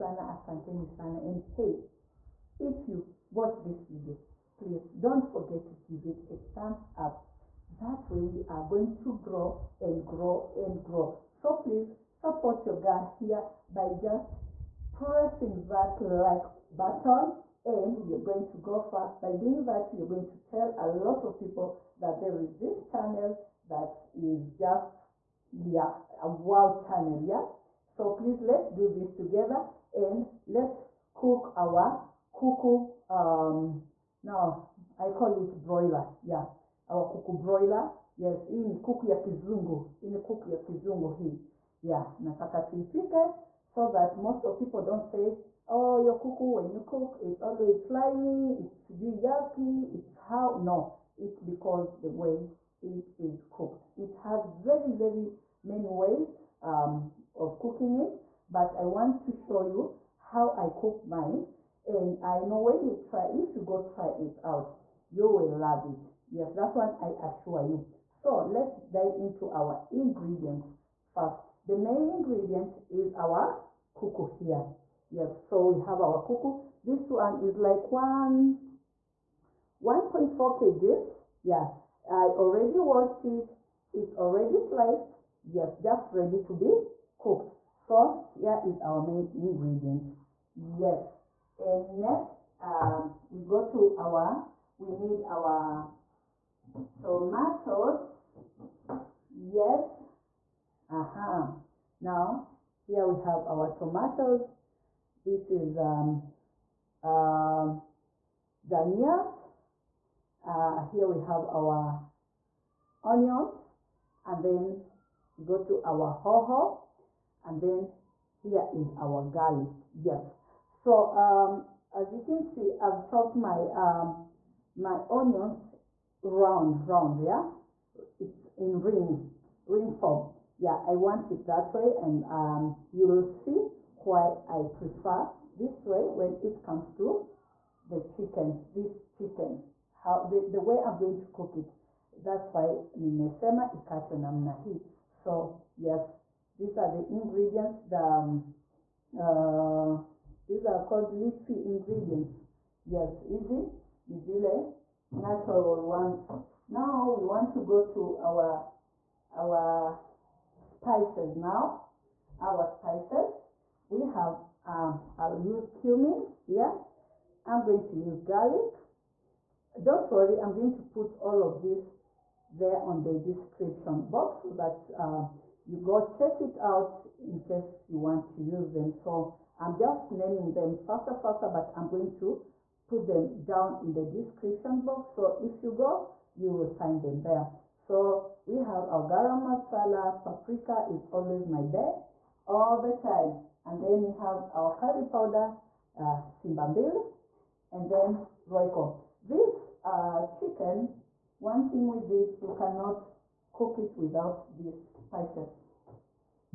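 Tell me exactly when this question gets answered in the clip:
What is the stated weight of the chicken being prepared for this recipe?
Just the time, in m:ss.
1:19.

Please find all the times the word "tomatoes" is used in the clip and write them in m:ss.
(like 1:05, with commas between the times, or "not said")
1:36, 1:43.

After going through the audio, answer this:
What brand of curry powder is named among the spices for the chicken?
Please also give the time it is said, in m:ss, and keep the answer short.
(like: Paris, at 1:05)
Simba Mbili, at 3:16.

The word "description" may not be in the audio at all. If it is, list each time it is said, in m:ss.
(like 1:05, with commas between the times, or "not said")
2:53, 3:04.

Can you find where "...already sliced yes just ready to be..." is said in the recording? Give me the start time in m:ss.
1:24.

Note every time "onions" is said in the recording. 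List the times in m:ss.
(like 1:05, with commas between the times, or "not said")
1:53, 2:05.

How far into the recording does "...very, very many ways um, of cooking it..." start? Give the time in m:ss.
0:54.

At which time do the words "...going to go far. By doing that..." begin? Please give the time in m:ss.
0:18.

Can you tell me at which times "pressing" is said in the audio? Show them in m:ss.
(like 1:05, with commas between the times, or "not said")
0:14.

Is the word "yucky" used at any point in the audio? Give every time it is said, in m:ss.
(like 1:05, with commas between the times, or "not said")
0:48.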